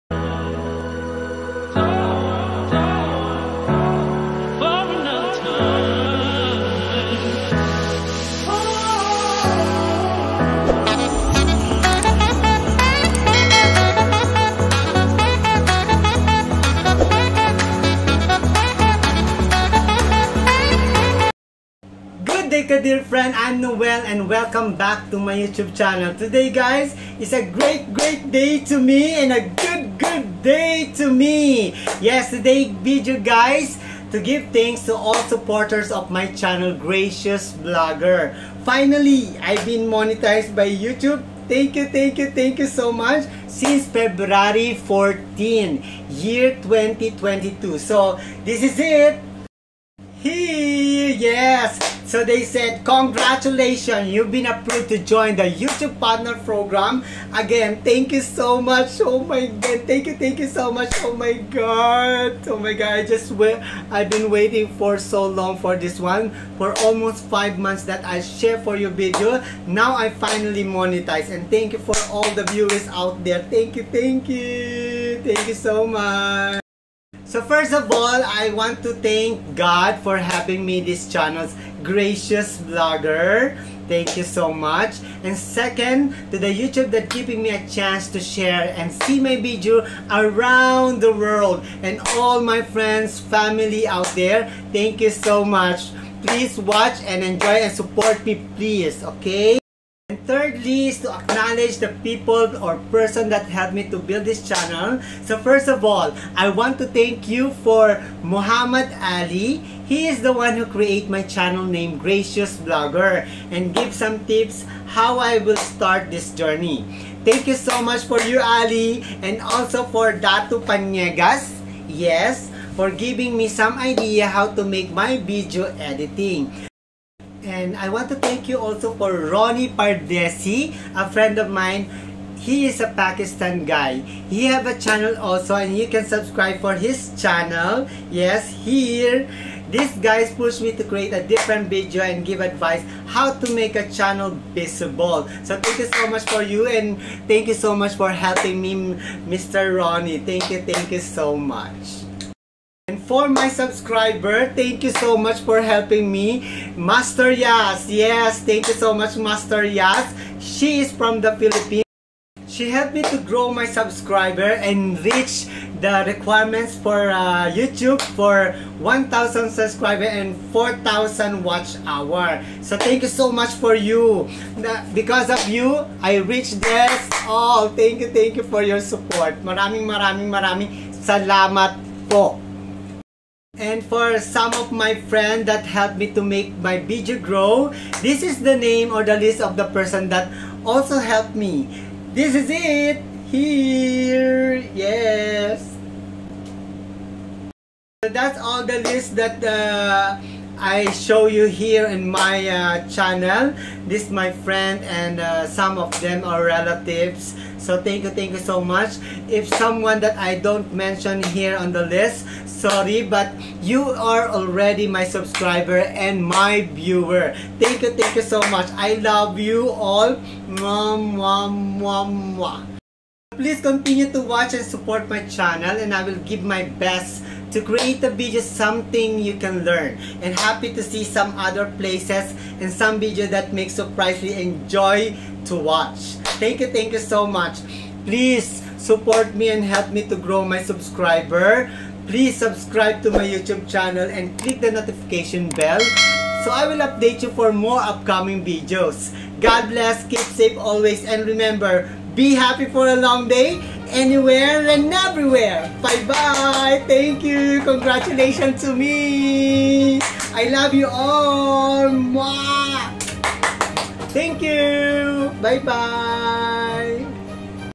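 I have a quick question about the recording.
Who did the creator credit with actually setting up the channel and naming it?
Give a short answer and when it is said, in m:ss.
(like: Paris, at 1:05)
Muhammad Ali, at 1:48.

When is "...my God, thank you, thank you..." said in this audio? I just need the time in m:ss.
0:59.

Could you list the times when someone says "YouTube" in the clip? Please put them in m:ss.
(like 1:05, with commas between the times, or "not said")
0:25, 0:40, 0:55, 1:26, 2:47, 4:03.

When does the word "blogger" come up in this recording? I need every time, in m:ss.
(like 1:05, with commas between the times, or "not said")
0:37, 1:22, 1:52.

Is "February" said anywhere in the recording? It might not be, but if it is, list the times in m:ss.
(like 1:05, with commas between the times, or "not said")
0:43.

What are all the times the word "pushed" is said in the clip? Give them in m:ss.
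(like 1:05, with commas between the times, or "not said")
2:20.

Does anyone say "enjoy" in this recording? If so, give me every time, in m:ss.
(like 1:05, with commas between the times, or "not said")
1:37, 3:54.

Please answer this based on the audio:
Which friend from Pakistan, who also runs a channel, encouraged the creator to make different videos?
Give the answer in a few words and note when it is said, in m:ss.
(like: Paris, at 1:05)
Ronnie Pardesi, at 2:09.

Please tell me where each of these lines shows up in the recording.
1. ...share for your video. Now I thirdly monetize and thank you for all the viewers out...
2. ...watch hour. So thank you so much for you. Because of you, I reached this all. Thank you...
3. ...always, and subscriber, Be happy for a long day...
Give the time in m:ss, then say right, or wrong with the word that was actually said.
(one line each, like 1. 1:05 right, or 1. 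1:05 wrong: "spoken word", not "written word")
1. 1:08 wrong: "finally", not "thirdly"
2. 2:51 right
3. 4:10 wrong: "remember", not "subscriber".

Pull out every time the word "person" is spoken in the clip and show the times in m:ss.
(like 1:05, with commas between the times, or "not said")
1:42, 3:09.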